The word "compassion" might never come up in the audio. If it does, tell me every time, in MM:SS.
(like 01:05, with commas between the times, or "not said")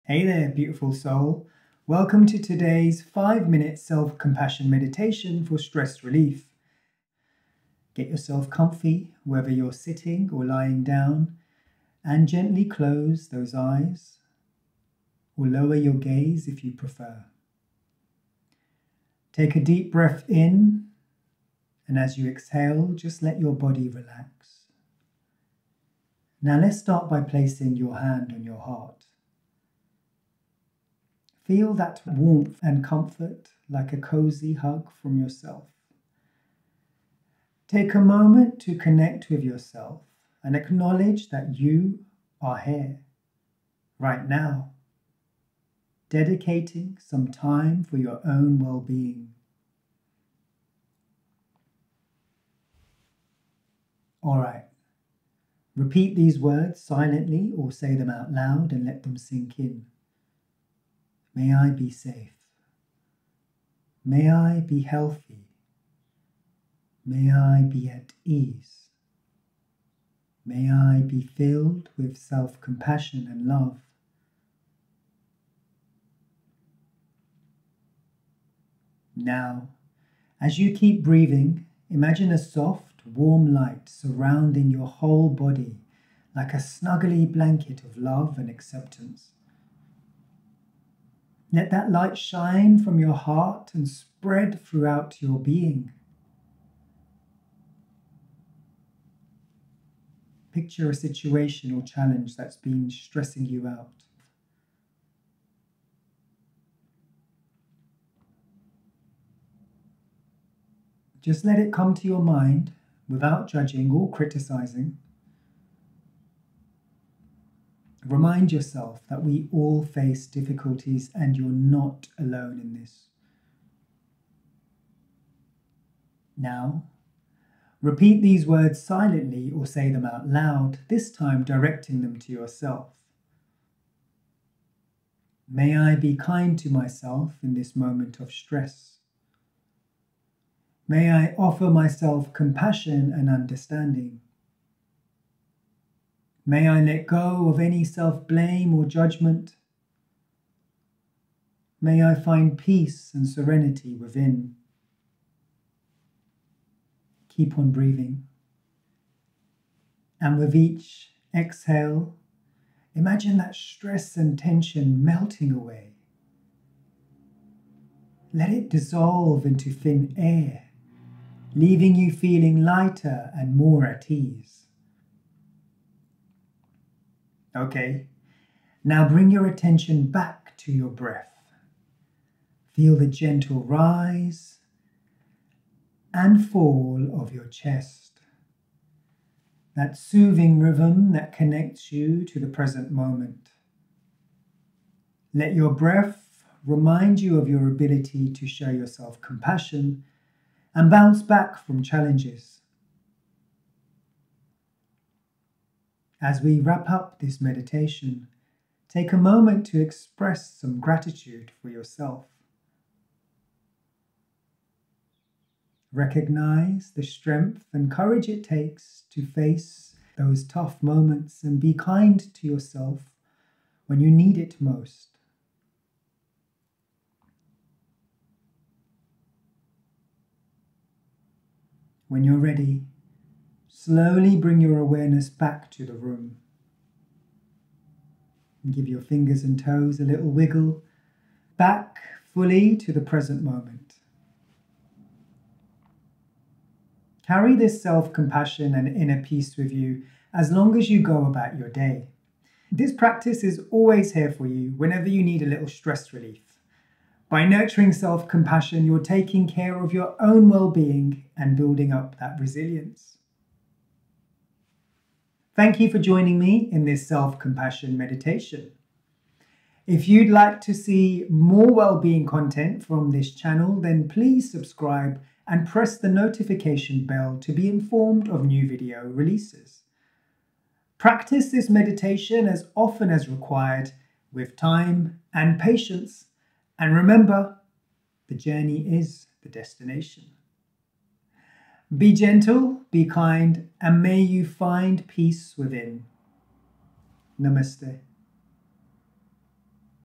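00:04, 01:12, 02:22, 03:19, 04:08, 04:18, 04:27.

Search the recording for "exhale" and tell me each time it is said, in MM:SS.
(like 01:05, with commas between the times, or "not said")
00:22, 02:41.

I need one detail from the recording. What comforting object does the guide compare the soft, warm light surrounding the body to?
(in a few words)
Snuggly blanket.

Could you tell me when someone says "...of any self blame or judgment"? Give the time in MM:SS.
02:27.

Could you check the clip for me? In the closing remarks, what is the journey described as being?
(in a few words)
The destination.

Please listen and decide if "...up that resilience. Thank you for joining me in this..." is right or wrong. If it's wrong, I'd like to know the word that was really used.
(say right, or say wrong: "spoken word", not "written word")
right.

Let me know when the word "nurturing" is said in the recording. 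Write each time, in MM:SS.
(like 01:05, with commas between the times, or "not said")
04:17.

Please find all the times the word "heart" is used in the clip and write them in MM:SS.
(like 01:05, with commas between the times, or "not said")
00:28, 01:33.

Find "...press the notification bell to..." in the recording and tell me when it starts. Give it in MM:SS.
04:35.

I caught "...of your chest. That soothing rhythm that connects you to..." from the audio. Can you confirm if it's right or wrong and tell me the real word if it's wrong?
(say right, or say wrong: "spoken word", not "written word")
right.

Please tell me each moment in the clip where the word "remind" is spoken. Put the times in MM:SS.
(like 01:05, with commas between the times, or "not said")
01:58, 03:16.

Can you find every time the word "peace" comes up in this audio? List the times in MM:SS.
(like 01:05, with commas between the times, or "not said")
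02:32, 04:09, 04:55.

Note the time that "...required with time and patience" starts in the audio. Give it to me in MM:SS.
04:43.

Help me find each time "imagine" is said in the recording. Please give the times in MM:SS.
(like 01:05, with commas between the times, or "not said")
01:21, 02:42.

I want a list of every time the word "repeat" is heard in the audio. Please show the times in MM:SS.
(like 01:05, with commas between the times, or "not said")
00:55, 02:07.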